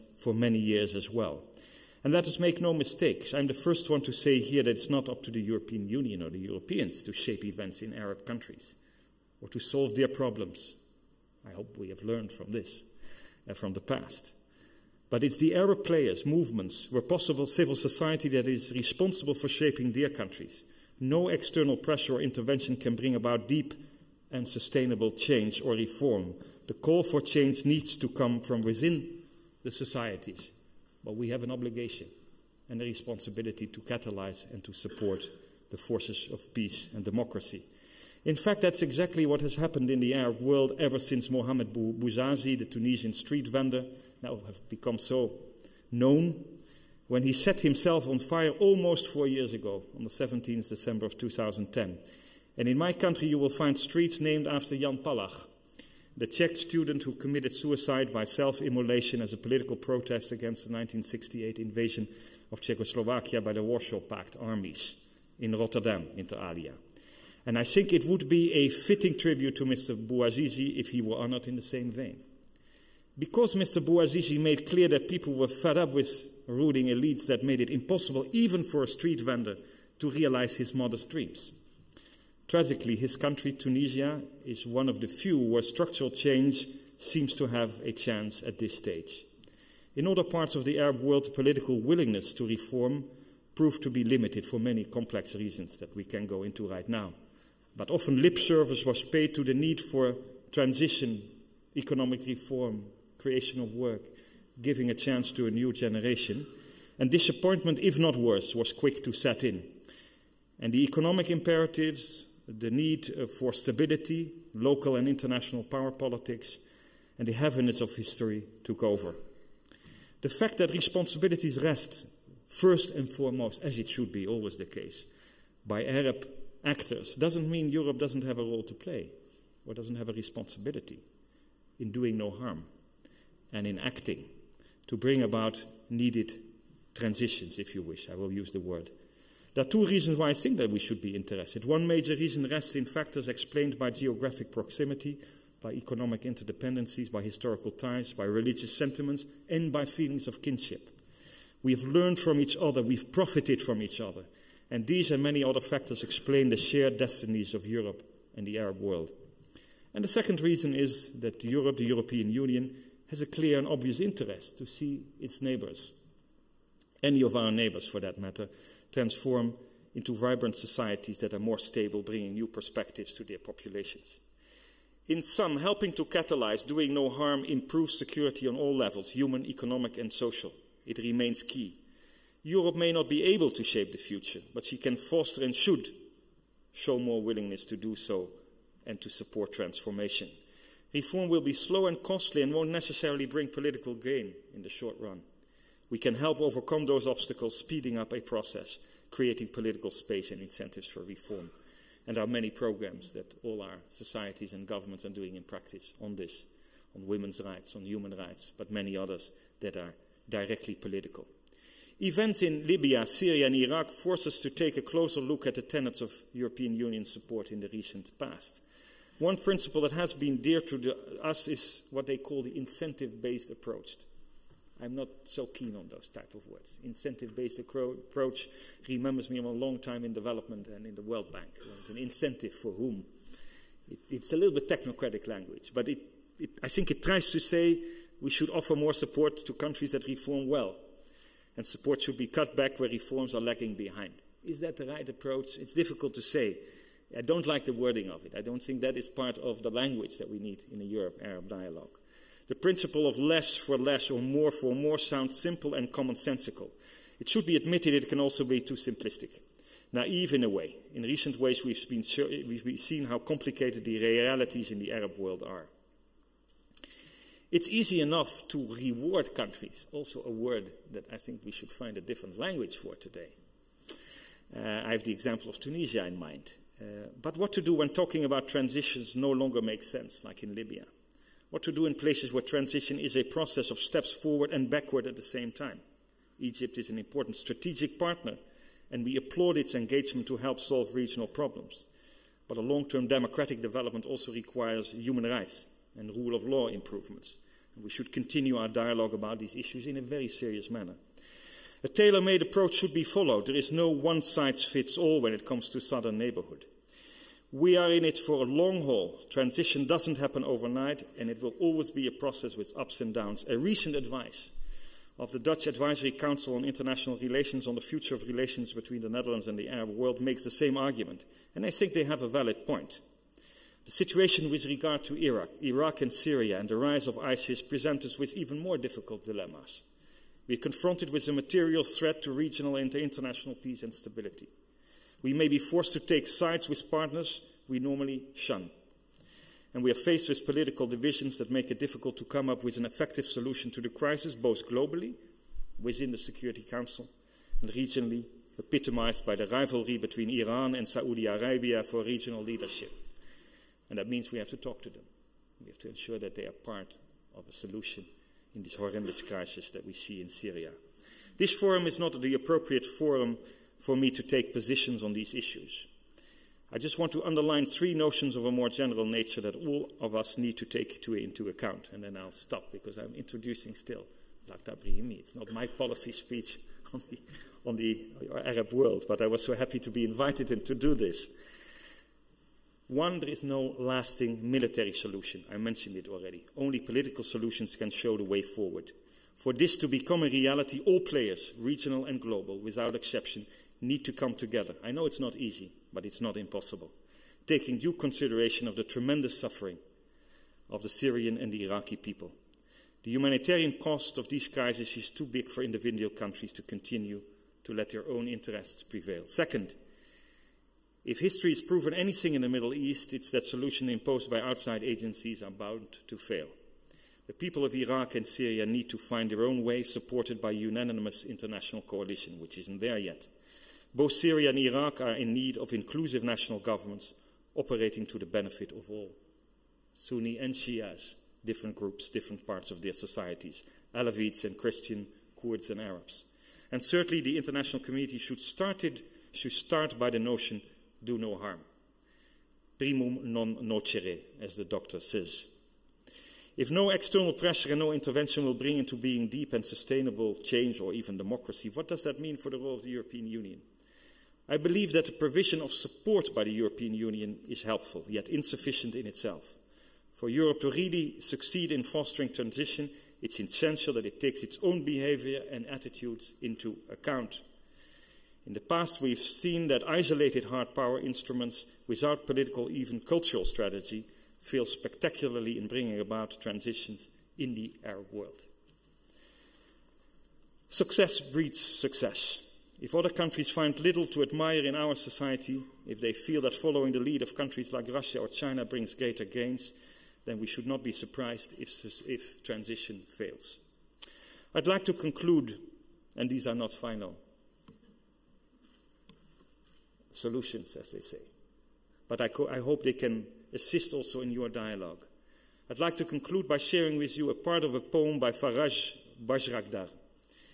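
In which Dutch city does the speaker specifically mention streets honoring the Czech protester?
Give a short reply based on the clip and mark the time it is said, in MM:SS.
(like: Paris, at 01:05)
Rotterdam, at 01:05.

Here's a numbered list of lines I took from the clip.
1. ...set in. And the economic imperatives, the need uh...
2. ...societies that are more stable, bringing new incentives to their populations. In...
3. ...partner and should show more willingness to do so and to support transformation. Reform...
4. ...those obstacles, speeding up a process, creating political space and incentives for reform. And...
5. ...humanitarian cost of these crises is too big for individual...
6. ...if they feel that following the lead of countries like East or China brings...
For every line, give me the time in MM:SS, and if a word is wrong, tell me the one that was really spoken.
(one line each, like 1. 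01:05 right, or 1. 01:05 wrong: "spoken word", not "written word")
1. 01:49 right
2. 02:50 wrong: "perspectives", not "incentives"
3. 03:04 wrong: "foster", not "partner"
4. 03:16 right
5. 06:43 right
6. 08:05 wrong: "Russia", not "East".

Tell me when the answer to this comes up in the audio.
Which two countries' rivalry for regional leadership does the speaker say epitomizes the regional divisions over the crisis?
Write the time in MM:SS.
05:50.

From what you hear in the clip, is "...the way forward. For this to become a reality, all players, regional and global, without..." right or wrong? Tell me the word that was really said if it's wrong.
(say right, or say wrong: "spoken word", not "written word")
right.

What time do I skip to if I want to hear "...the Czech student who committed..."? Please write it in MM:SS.
00:56.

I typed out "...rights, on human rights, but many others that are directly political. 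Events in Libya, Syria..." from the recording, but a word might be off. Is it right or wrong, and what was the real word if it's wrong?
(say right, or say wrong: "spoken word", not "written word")
right.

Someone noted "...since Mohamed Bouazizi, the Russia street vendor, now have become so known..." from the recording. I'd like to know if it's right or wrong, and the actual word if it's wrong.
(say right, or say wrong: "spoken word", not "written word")
wrong: "Tunisian", not "Russia".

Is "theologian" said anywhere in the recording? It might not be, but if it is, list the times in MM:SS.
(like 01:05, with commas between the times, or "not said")
not said.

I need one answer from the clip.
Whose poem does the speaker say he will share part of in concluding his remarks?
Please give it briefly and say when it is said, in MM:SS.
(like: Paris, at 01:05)
Faraj Bayrakdar, at 08:28.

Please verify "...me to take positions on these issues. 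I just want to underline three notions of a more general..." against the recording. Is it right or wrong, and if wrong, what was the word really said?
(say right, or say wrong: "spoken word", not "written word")
right.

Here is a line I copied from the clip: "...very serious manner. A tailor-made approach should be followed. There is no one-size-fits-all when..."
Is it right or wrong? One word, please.
right.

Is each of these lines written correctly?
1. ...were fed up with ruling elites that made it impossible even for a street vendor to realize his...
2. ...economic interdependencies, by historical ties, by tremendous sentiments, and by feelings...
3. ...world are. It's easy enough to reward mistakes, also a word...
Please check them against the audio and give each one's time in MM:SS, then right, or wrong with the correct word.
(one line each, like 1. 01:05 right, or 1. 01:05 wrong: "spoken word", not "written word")
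1. 01:15 right
2. 02:25 wrong: "religious", not "tremendous"
3. 04:25 wrong: "countries", not "mistakes".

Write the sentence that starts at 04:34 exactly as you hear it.
Uh, I have the example of Tunisia in mind.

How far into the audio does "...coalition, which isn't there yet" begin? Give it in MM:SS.
07:01.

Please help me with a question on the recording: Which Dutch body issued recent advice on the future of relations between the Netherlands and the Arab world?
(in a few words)
Dutch Advisory Council on International Relations.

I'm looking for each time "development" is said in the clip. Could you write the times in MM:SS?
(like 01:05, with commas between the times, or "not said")
03:50, 04:53.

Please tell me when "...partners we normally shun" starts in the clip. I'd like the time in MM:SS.
05:36.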